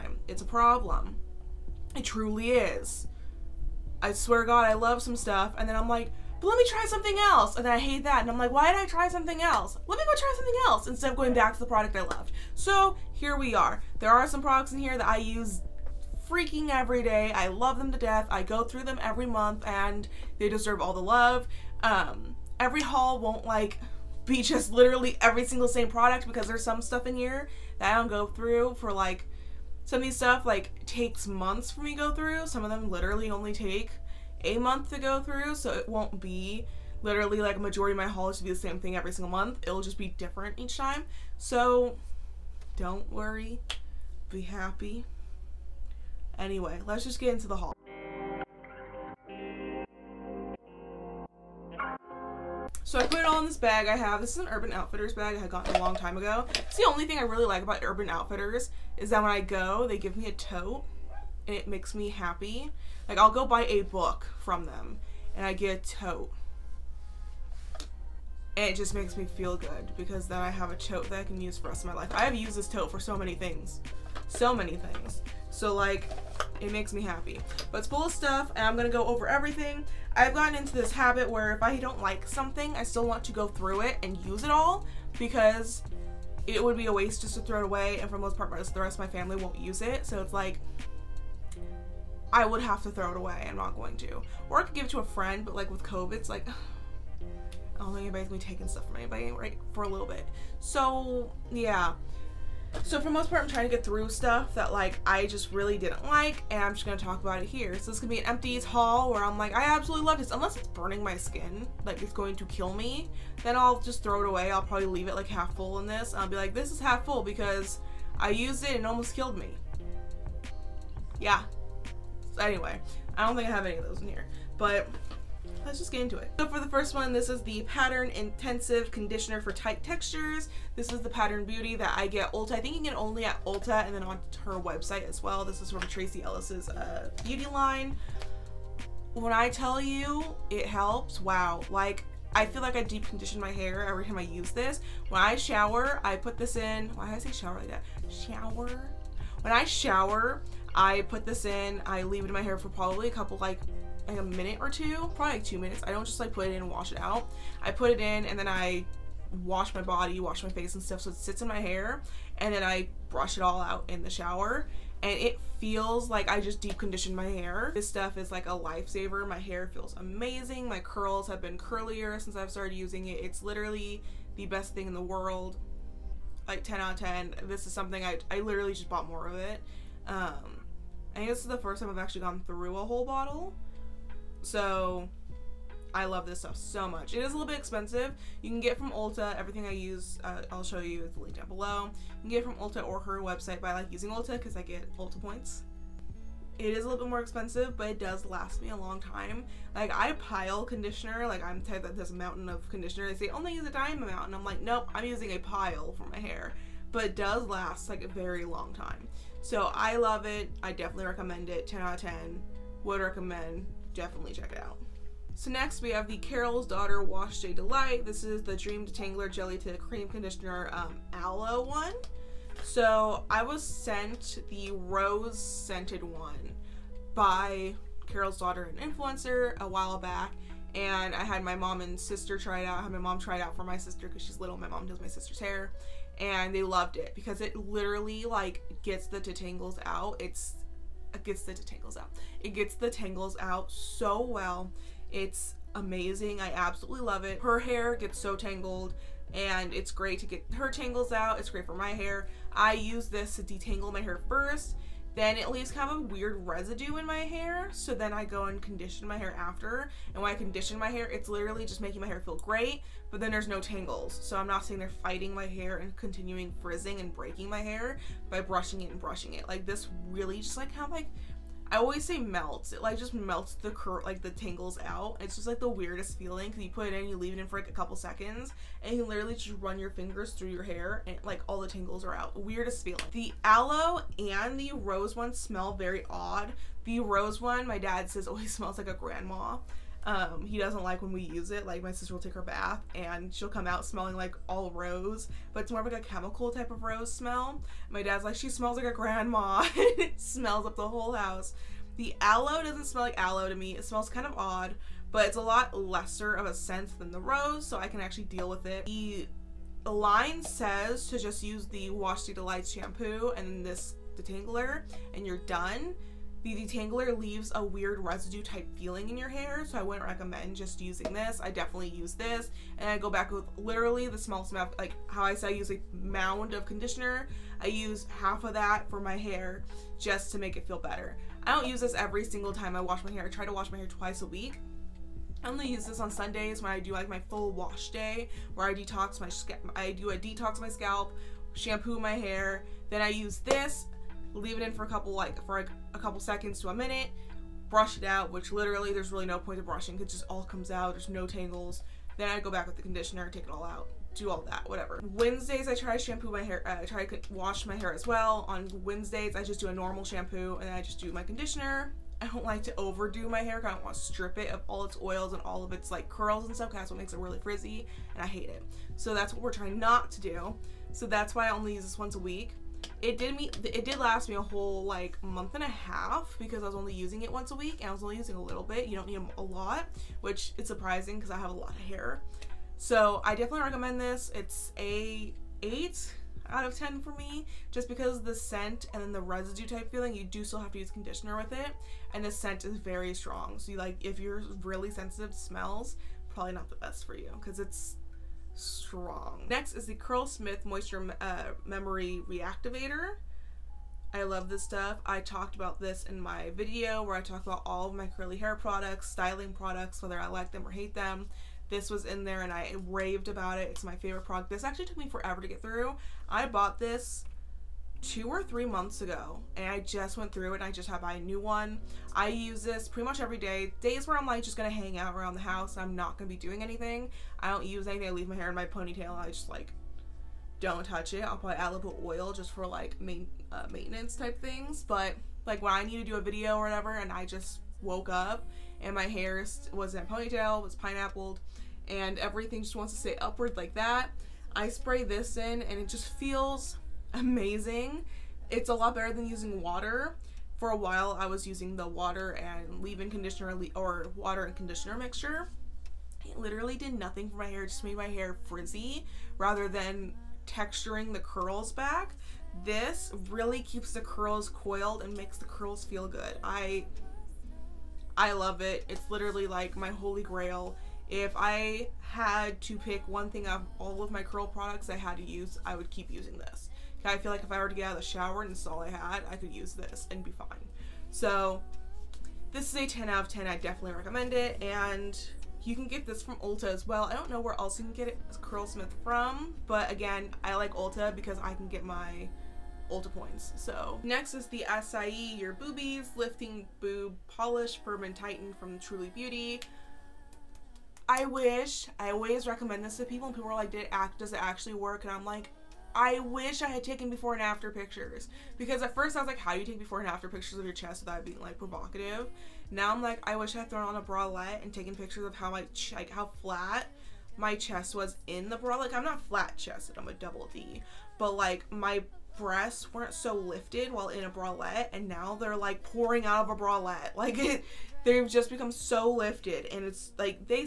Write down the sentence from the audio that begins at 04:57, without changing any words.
My dad's like, she smells like a grandma.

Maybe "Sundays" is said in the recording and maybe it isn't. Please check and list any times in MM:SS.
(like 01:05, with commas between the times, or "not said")
05:36.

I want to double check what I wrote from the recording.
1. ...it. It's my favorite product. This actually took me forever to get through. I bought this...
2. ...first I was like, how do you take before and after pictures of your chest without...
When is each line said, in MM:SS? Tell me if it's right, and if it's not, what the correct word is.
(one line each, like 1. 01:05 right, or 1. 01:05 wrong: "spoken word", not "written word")
1. 06:53 right
2. 08:28 right.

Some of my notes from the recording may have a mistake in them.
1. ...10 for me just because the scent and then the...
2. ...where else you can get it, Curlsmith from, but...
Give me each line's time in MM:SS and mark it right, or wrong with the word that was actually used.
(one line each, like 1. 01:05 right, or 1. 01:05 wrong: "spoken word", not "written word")
1. 06:26 right
2. 08:07 right.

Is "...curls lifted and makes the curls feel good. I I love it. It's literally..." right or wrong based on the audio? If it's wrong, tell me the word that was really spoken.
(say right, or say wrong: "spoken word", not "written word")
wrong: "coiled", not "lifted".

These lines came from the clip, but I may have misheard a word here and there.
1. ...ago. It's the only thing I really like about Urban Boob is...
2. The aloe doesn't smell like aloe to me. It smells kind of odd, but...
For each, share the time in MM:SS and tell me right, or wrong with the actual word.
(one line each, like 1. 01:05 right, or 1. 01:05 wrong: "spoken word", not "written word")
1. 00:56 wrong: "Outfitters", not "Boob"
2. 05:01 right.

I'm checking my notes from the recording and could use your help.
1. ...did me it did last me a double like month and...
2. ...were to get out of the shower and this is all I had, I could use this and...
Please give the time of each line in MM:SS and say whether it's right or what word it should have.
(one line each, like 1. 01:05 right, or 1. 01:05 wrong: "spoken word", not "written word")
1. 06:13 wrong: "whole", not "double"
2. 07:57 right.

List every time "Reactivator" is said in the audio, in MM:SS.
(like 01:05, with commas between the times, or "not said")
06:42.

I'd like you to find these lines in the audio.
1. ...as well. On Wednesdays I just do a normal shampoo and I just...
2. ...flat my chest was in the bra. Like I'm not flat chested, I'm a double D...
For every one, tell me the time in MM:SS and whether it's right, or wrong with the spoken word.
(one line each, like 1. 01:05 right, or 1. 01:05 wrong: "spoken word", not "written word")
1. 05:57 right
2. 08:36 right.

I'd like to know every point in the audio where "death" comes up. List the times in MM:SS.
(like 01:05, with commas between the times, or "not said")
00:17.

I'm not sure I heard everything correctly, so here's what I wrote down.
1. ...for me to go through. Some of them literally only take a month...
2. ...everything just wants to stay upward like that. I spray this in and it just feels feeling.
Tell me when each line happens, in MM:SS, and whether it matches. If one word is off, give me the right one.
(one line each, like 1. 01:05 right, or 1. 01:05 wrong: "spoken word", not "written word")
1. 00:31 right
2. 07:22 wrong: "amazing", not "feeling".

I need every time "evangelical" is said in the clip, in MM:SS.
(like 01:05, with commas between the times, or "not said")
not said.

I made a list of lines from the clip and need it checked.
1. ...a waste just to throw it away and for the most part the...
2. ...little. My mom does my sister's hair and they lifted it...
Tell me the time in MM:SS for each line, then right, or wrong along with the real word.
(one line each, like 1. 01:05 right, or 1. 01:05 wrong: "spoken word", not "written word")
1. 01:26 right
2. 03:54 wrong: "loved", not "lifted".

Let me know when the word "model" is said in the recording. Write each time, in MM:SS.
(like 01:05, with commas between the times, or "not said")
not said.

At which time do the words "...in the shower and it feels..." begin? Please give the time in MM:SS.
02:43.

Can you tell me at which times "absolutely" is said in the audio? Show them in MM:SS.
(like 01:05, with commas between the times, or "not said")
01:49, 04:06.